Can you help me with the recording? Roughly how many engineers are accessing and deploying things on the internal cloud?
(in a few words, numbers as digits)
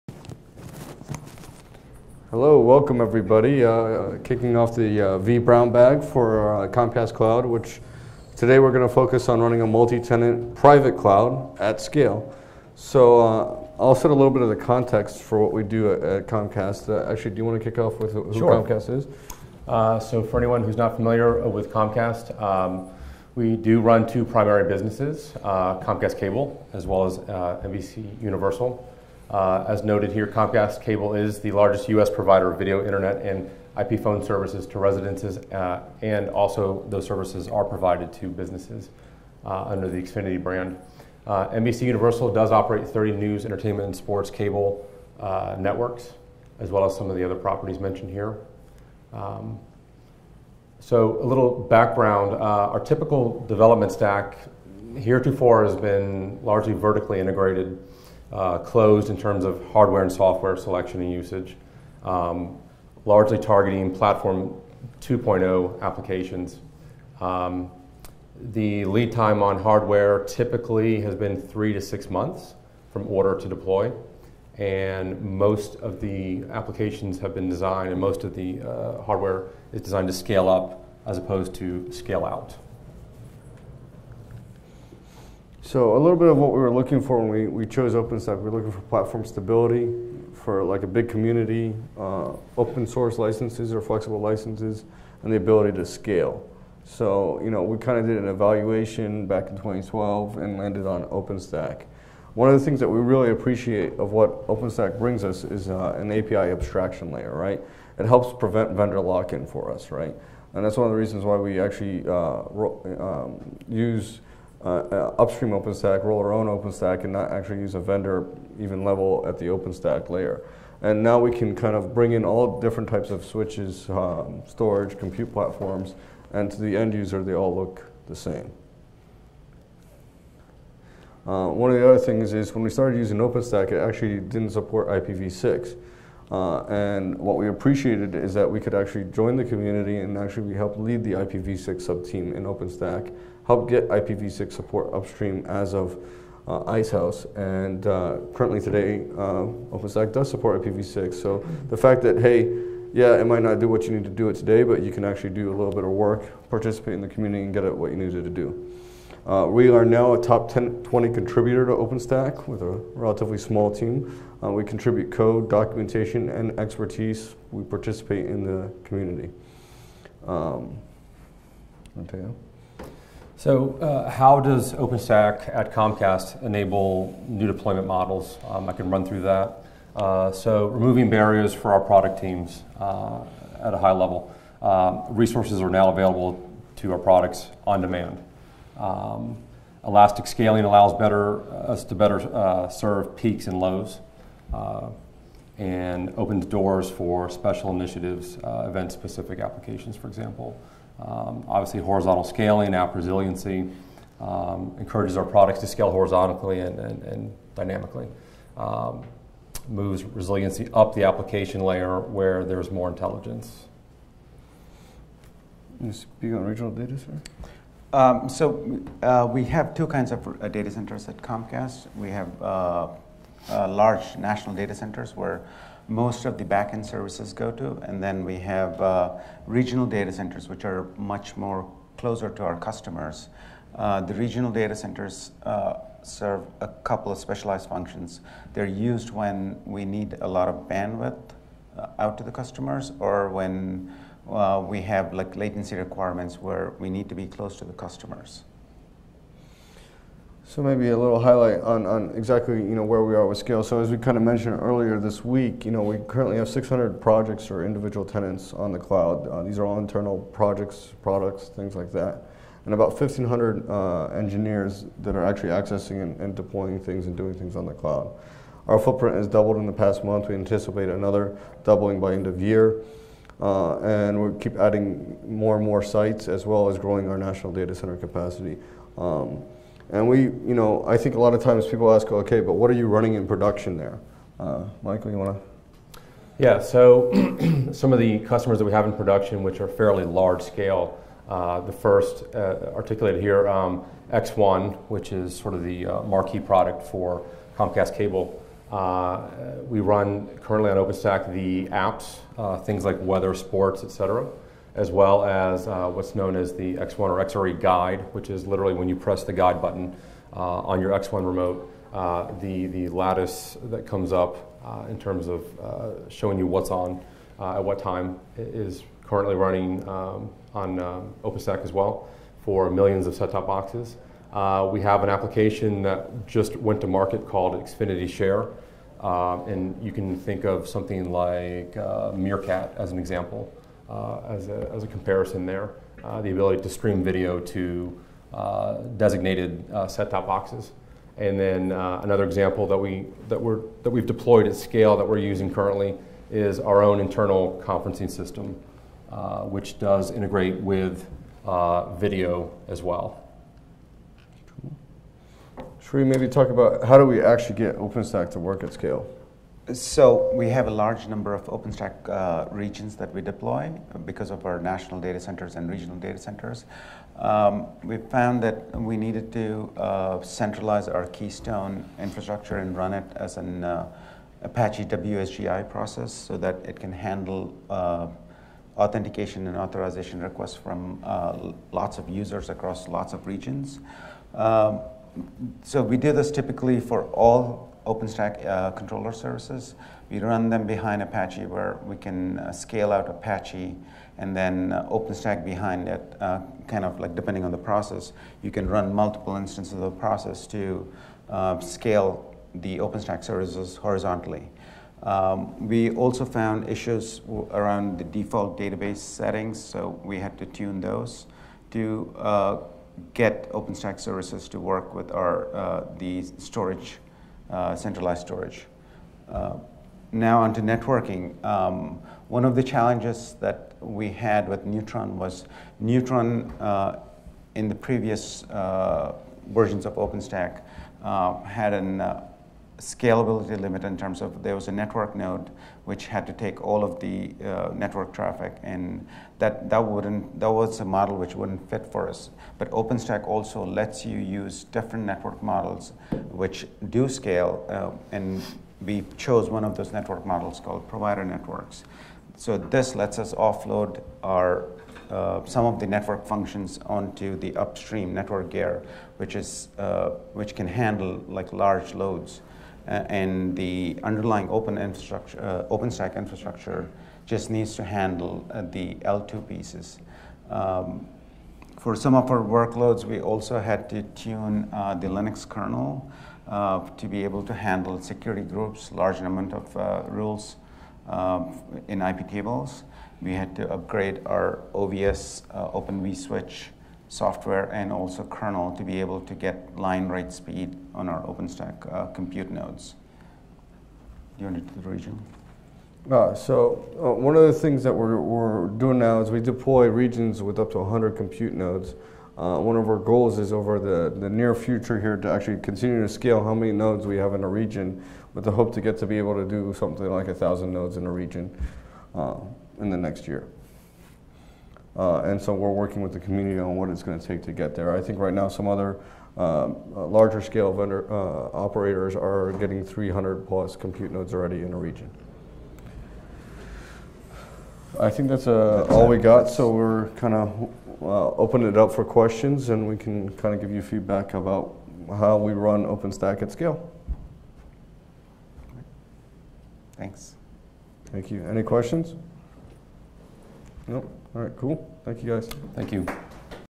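1,500.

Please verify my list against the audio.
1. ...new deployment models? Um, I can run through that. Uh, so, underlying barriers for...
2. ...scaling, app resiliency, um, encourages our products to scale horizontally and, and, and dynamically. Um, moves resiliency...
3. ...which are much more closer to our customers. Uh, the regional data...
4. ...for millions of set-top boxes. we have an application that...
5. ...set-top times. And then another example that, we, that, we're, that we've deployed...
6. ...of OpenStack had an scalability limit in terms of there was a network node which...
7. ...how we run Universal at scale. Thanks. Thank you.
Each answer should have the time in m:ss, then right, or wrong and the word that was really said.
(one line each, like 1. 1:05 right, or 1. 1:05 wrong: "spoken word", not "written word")
1. 2:57 wrong: "removing", not "underlying"
2. 3:22 right
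3. 3:50 right
4. 5:22 right
5. 5:39 wrong: "boxes", not "times"
6. 7:09 right
7. 8:55 wrong: "OpenStack", not "Universal".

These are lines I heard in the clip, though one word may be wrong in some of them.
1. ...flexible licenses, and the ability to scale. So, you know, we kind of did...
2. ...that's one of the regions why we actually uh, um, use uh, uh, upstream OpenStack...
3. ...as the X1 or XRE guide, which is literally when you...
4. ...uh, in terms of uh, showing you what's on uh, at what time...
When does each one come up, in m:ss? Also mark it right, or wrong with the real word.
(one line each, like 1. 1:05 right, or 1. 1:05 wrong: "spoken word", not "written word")
1. 1:33 right
2. 1:50 wrong: "reasons", not "regions"
3. 5:06 right
4. 5:14 right.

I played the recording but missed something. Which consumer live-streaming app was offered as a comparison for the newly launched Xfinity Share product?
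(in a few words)
Meerkat.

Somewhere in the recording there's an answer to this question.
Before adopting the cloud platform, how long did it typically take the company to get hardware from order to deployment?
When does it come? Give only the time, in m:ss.
1:11.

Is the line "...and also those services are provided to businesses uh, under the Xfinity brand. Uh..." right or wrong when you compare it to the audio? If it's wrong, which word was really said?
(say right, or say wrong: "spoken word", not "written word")
right.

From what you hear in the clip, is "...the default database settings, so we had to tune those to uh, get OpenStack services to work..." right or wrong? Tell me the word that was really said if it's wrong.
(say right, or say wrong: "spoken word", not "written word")
right.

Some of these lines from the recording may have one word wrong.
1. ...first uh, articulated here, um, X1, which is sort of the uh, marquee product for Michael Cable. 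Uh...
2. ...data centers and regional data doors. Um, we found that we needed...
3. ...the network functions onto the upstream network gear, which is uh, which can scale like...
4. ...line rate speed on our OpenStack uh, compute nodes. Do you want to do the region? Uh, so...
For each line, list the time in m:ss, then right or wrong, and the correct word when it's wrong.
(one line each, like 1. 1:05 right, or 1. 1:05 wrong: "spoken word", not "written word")
1. 4:51 wrong: "Comcast", not "Michael"
2. 6:04 wrong: "centers", not "doors"
3. 7:35 wrong: "handle", not "scale"
4. 8:09 right.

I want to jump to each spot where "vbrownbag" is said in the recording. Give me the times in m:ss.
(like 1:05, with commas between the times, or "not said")
0:05.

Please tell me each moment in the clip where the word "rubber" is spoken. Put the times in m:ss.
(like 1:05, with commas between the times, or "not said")
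not said.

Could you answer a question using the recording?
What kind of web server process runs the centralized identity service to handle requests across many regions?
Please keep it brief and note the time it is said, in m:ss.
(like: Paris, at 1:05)
Apache WSGI, at 6:14.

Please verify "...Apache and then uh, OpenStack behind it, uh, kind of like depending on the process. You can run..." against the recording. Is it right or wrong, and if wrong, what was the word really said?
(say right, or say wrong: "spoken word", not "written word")
right.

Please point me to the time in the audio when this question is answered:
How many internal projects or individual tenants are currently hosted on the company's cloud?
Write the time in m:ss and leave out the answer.
4:16.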